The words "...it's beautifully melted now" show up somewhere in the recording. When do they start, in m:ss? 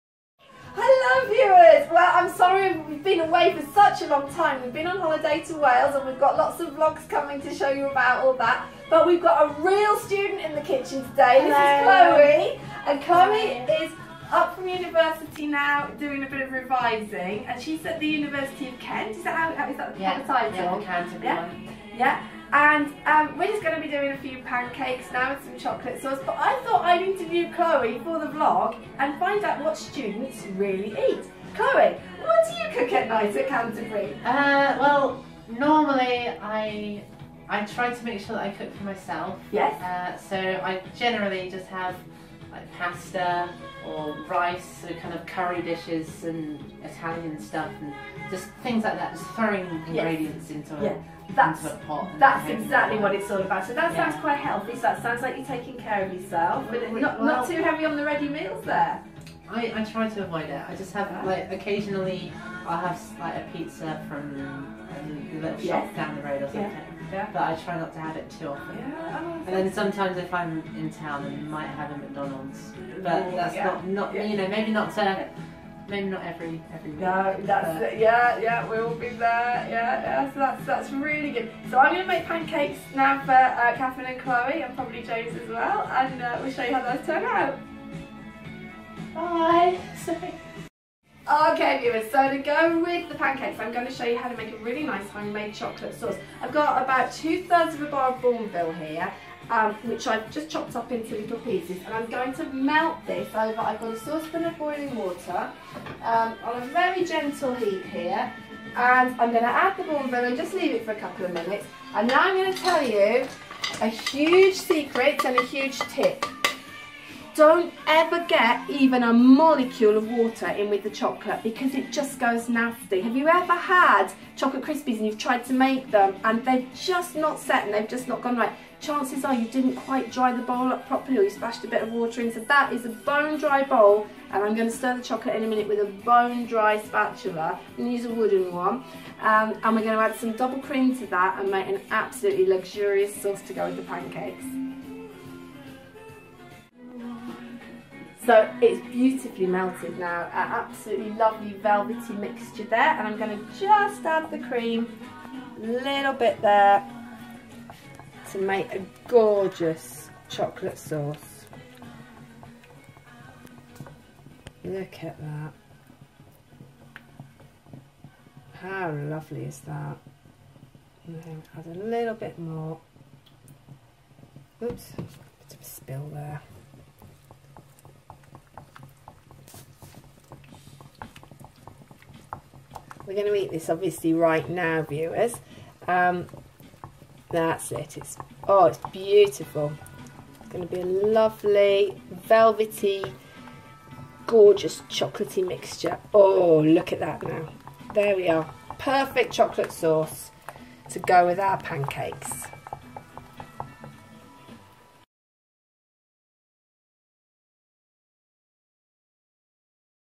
2:28.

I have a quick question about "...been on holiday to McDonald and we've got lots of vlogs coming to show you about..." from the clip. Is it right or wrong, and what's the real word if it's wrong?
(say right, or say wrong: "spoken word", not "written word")
wrong: "Wales", not "McDonald".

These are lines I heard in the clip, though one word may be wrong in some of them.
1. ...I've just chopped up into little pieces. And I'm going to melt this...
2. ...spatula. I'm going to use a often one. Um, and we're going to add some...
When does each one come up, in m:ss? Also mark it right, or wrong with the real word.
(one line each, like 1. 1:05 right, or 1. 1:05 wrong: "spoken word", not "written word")
1. 1:40 right
2. 2:16 wrong: "wooden", not "often".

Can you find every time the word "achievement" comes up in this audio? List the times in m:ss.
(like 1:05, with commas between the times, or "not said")
not said.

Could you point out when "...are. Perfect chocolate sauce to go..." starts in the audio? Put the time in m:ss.
3:18.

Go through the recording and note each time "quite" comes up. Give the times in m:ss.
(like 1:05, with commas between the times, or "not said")
0:54, 2:09.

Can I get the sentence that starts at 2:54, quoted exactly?
Oops, bit of a spill there.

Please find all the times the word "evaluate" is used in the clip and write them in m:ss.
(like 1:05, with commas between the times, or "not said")
not said.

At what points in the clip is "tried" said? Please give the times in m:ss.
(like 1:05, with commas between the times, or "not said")
2:05.